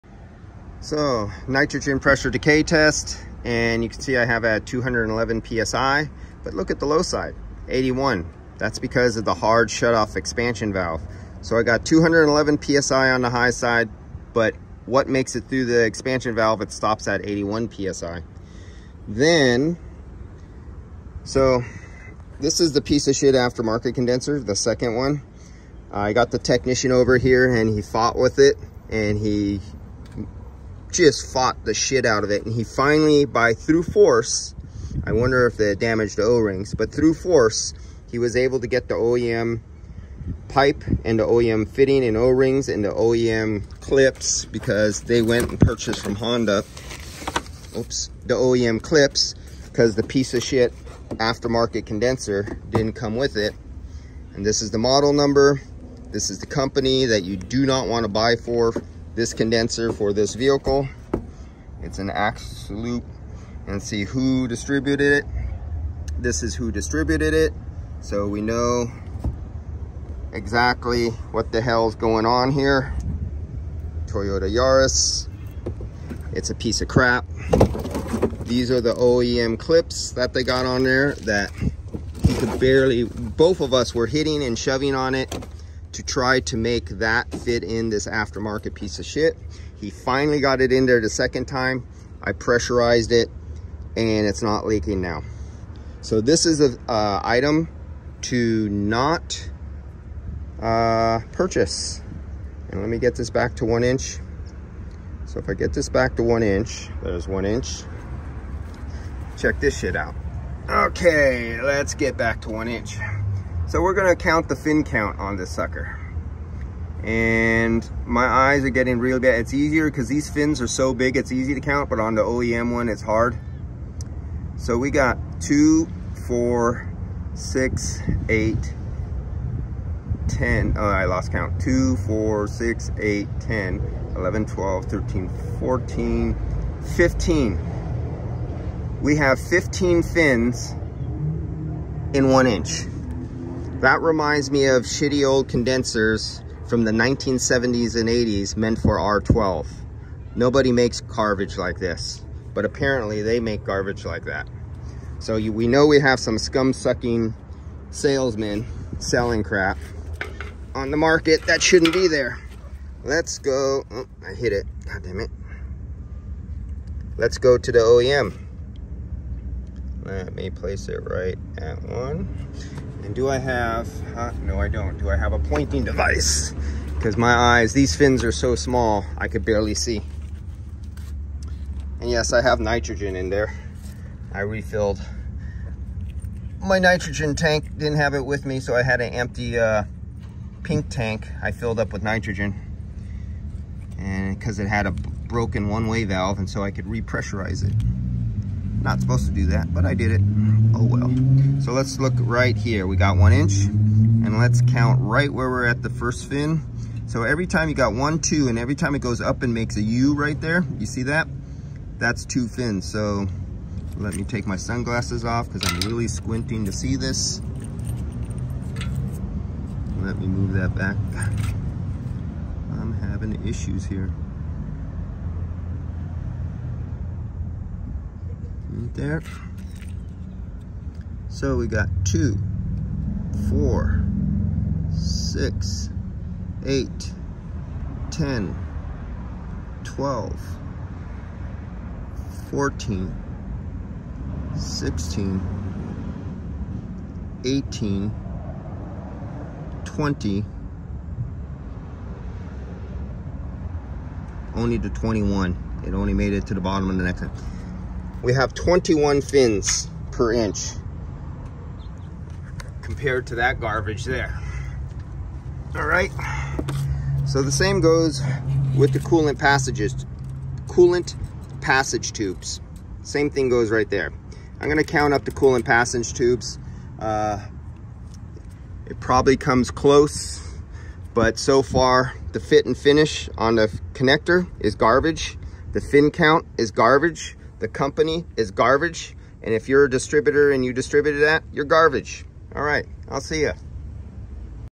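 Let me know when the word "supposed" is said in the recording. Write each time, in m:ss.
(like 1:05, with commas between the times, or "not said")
3:18.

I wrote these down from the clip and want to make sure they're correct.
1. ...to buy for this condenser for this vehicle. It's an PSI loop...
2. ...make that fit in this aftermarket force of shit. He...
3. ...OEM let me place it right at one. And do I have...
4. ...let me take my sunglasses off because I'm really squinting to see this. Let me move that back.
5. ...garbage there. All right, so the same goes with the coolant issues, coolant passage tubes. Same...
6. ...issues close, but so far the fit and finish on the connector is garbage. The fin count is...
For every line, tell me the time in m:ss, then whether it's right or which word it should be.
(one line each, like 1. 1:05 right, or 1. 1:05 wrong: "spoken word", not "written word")
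1. 0:58 wrong: "Axe", not "PSI"
2. 1:26 wrong: "piece", not "force"
3. 2:47 right
4. 3:33 right
5. 4:23 wrong: "passages", not "issues"
6. 4:39 wrong: "comes", not "issues".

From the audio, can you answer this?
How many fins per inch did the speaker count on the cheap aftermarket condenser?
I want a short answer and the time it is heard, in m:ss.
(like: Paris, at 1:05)
15, at 2:19.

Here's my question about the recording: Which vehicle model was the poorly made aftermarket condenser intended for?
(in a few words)
Toyota Yaris.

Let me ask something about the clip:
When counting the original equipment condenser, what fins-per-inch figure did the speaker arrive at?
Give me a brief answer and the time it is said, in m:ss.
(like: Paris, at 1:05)
21, at 4:18.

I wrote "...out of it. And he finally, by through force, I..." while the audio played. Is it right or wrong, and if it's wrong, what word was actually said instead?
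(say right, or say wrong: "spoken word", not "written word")
right.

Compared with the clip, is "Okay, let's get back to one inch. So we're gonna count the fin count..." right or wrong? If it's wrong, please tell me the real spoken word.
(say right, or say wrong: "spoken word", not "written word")
right.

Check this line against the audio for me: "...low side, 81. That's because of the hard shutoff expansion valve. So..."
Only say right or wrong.
right.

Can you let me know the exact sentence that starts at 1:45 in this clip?
So if I get this back to one inch, there's one inch.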